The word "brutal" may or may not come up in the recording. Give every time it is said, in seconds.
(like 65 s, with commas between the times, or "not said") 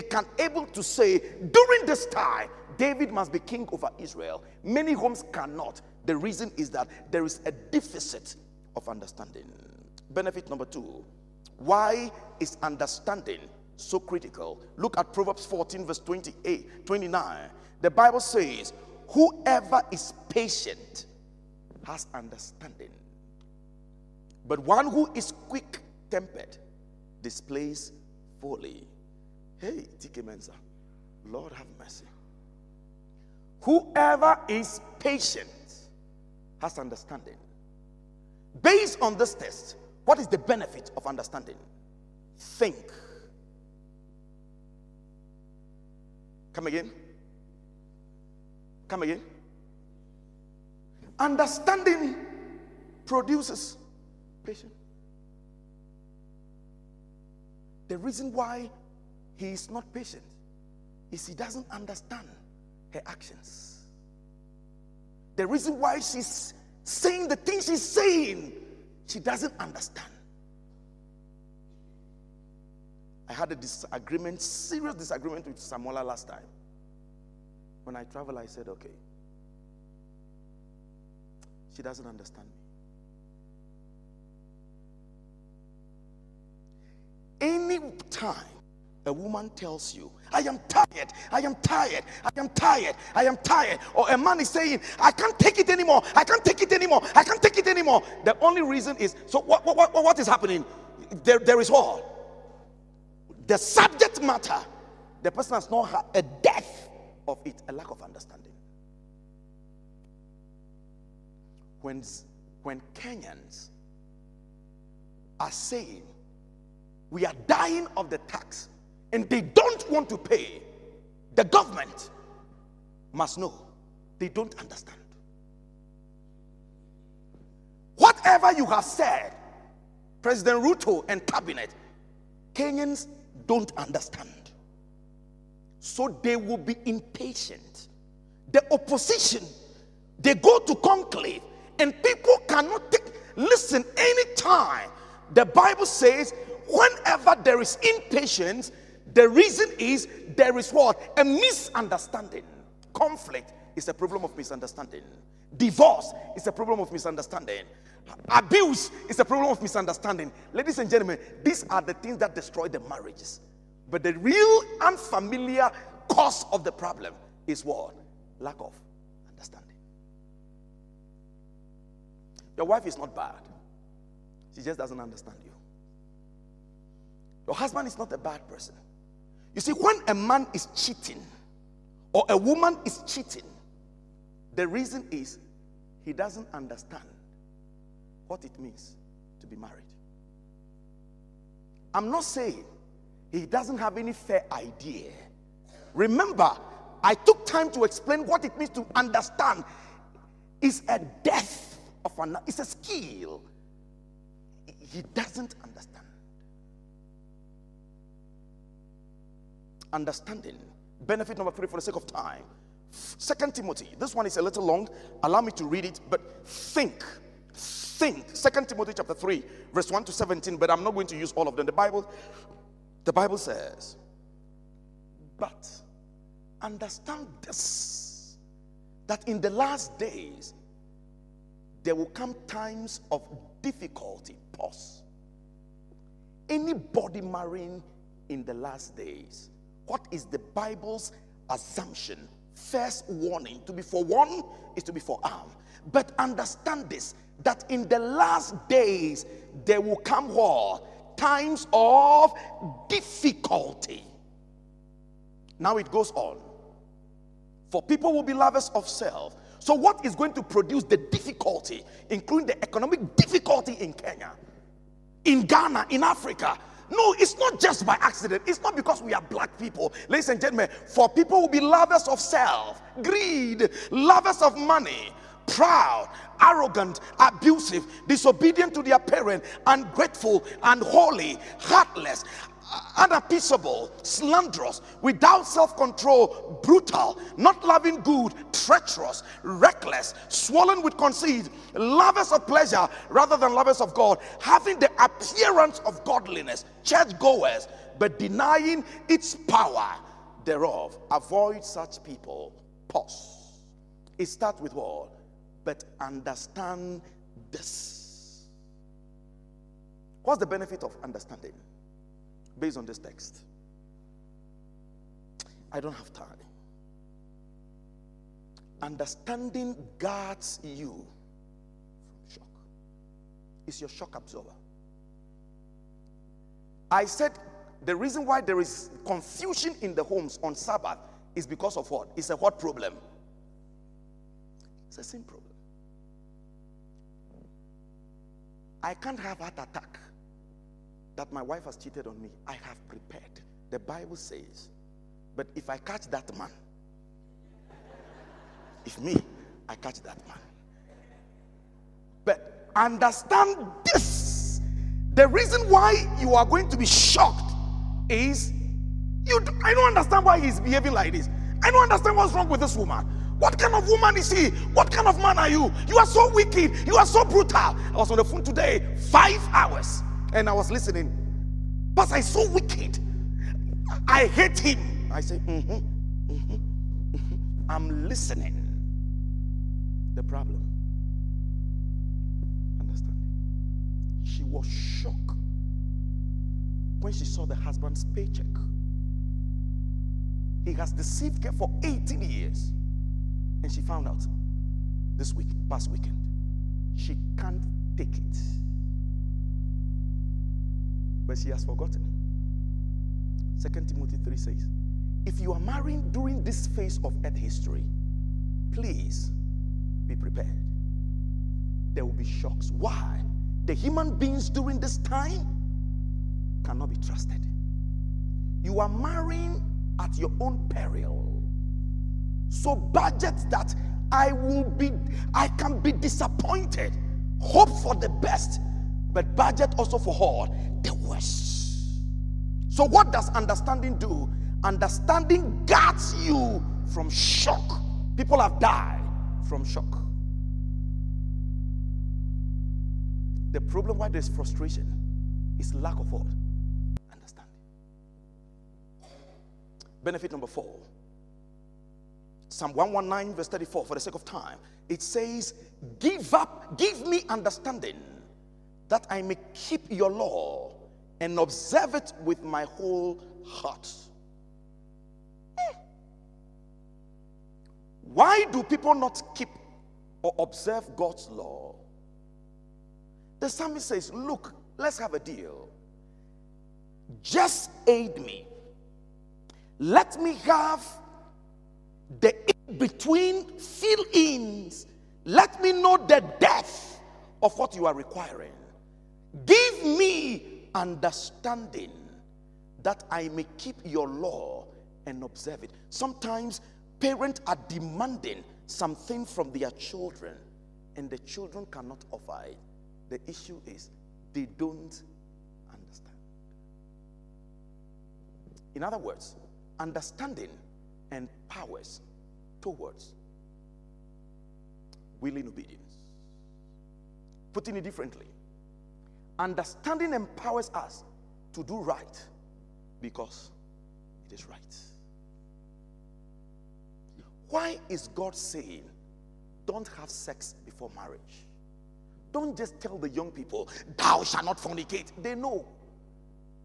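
286 s, 367 s.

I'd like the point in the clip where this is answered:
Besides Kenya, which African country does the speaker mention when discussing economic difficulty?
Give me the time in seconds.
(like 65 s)
265 s.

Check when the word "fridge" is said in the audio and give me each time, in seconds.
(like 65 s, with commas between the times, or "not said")
not said.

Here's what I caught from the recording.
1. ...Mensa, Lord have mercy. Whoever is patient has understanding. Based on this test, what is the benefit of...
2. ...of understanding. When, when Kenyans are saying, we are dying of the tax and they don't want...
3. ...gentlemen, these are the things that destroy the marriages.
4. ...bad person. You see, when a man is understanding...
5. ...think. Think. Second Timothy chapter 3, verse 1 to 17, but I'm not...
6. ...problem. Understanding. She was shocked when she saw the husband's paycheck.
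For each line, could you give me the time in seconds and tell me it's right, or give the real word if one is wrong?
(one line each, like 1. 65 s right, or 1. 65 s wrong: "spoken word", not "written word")
1. 30 s right
2. 107 s right
3. 160 s right
4. 178 s wrong: "cheating", not "understanding"
5. 216 s right
6. 380 s right.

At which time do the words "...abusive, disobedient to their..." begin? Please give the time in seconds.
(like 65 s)
277 s.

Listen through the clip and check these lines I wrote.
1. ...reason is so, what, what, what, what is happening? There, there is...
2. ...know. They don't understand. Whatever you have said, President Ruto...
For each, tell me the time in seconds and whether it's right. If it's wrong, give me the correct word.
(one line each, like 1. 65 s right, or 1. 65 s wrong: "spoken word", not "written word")
1. 98 s right
2. 123 s right.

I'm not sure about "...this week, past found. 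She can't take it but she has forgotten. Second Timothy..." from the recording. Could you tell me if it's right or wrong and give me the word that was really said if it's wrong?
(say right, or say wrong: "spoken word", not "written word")
wrong: "weekend", not "found".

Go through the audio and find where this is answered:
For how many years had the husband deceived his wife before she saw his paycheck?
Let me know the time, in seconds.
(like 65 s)
391 s.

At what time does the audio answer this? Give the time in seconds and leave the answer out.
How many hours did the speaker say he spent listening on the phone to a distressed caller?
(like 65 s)
368 s.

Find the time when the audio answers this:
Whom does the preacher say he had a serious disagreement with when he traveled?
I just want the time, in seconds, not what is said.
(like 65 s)
75 s.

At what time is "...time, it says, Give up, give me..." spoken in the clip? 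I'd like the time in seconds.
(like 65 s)
454 s.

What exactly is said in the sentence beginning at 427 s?
Hope for the best, but budget also for all the worst.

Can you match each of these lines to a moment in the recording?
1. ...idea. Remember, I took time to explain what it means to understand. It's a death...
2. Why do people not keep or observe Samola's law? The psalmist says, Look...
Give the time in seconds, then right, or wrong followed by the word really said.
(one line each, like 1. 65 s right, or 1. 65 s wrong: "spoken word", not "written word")
1. 194 s right
2. 468 s wrong: "God", not "Samola".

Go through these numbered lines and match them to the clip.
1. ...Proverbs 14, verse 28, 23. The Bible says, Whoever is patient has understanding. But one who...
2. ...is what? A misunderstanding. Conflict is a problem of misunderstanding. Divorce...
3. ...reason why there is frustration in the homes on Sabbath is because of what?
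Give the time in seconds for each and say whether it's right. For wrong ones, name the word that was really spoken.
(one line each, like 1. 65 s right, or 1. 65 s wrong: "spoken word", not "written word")
1. 15 s wrong: "29", not "23"
2. 150 s right
3. 327 s wrong: "confusion", not "frustration".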